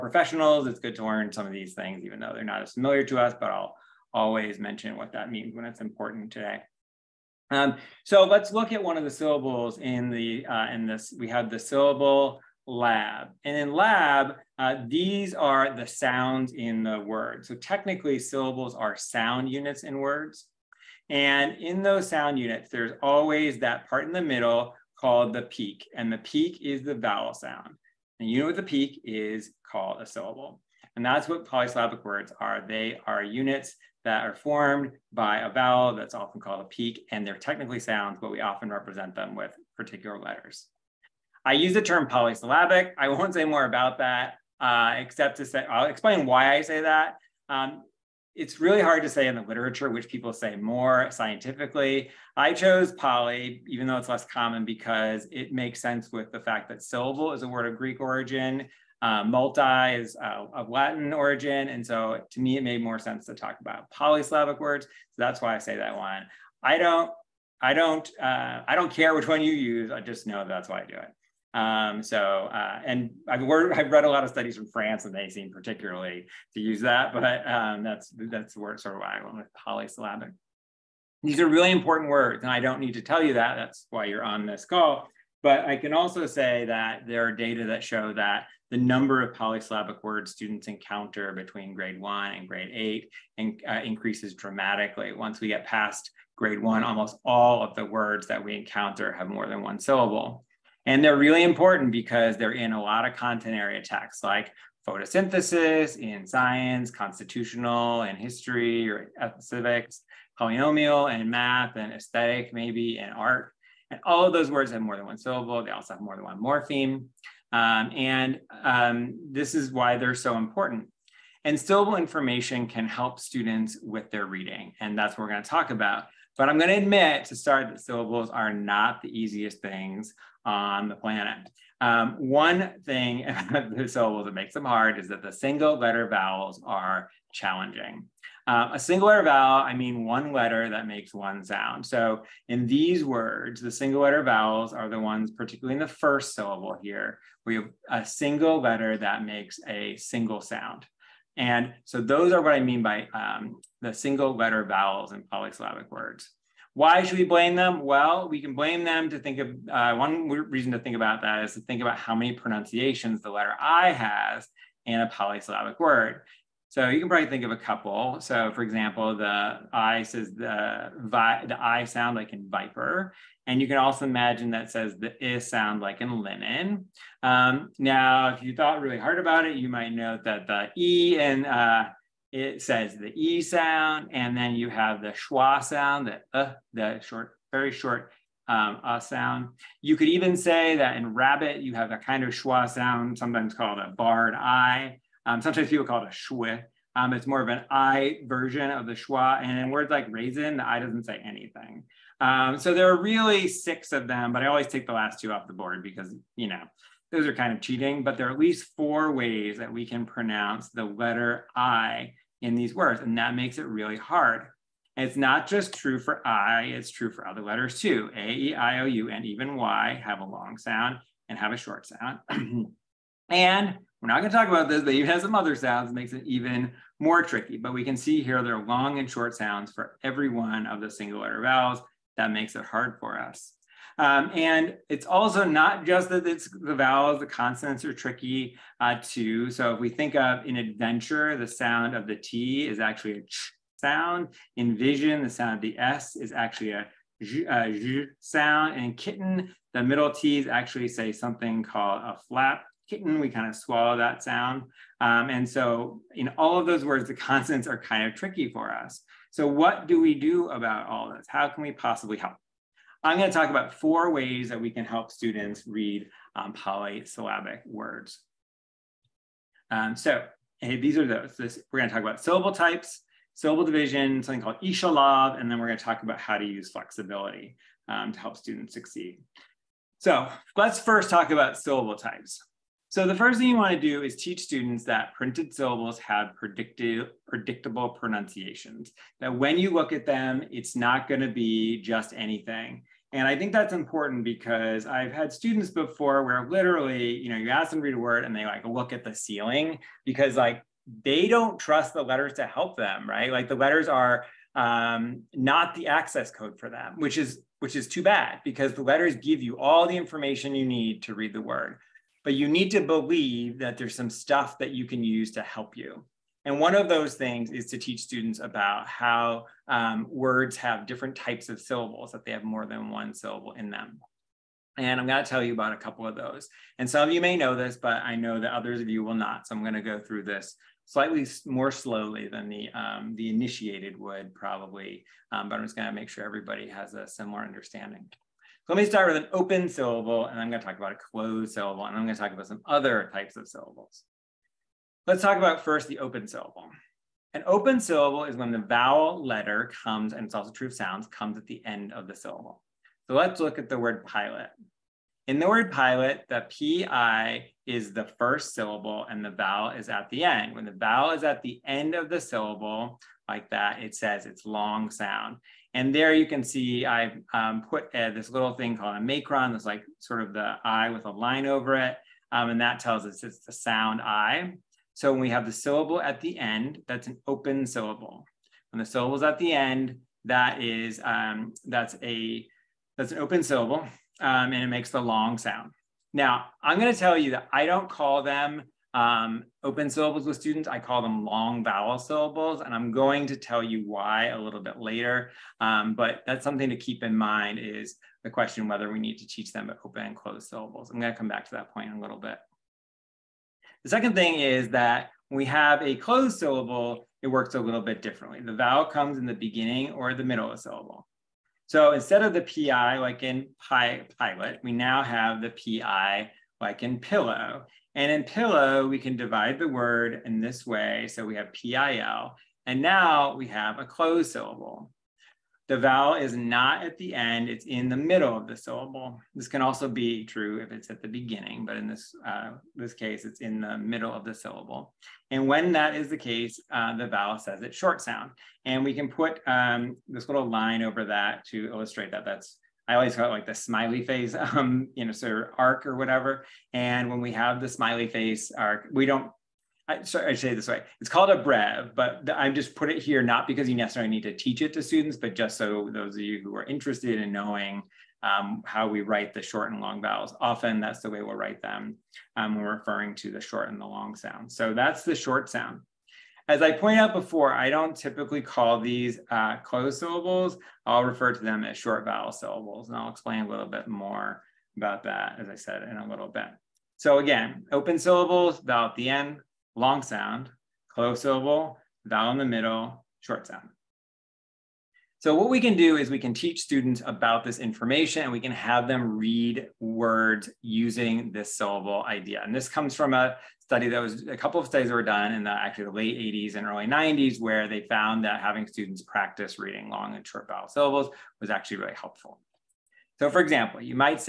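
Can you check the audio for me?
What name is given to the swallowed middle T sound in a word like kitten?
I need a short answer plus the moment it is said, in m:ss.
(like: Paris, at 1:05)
flap, at 4:12.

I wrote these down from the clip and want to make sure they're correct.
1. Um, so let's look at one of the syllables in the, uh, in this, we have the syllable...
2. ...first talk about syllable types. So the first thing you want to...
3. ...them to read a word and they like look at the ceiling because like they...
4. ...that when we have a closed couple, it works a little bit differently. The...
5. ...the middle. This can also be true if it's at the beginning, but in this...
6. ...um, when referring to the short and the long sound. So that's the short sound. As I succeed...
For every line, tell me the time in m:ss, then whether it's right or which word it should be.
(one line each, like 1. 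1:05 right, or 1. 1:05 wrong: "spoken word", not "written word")
1. 0:07 right
2. 4:40 right
3. 4:57 right
4. 6:44 wrong: "syllable", not "couple"
5. 7:08 wrong: "syllable", not "middle"
6. 7:42 wrong: "pointed", not "succeed".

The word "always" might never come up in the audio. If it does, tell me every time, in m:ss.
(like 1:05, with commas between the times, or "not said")
0:04, 0:23, 3:24, 7:22.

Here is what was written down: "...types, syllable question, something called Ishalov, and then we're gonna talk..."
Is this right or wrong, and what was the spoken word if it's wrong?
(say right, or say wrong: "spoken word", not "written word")
wrong: "division", not "question".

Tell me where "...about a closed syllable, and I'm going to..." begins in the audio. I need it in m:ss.
5:40.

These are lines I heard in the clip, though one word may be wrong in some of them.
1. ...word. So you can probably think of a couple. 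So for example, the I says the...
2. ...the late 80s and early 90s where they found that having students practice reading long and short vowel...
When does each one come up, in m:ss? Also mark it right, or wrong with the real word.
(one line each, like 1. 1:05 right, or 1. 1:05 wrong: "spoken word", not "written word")
1. 2:45 right
2. 8:15 right.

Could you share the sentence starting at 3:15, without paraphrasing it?
Um, sometimes people call it a schwa.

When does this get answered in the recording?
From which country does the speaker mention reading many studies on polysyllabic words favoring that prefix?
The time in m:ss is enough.
1:14.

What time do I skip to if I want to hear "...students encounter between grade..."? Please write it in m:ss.
1:30.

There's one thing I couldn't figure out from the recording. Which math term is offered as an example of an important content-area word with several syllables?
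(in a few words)
polynomial.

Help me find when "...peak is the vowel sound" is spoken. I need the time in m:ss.
0:26.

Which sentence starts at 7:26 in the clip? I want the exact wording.
And when we have the smiley face arc, we don't.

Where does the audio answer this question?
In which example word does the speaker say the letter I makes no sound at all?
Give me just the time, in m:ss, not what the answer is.
3:20.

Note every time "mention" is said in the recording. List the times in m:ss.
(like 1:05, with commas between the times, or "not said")
0:04.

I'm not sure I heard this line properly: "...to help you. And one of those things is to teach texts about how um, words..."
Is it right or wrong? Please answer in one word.
wrong.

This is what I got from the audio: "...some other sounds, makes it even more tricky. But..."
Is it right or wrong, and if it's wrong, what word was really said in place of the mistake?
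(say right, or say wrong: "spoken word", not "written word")
right.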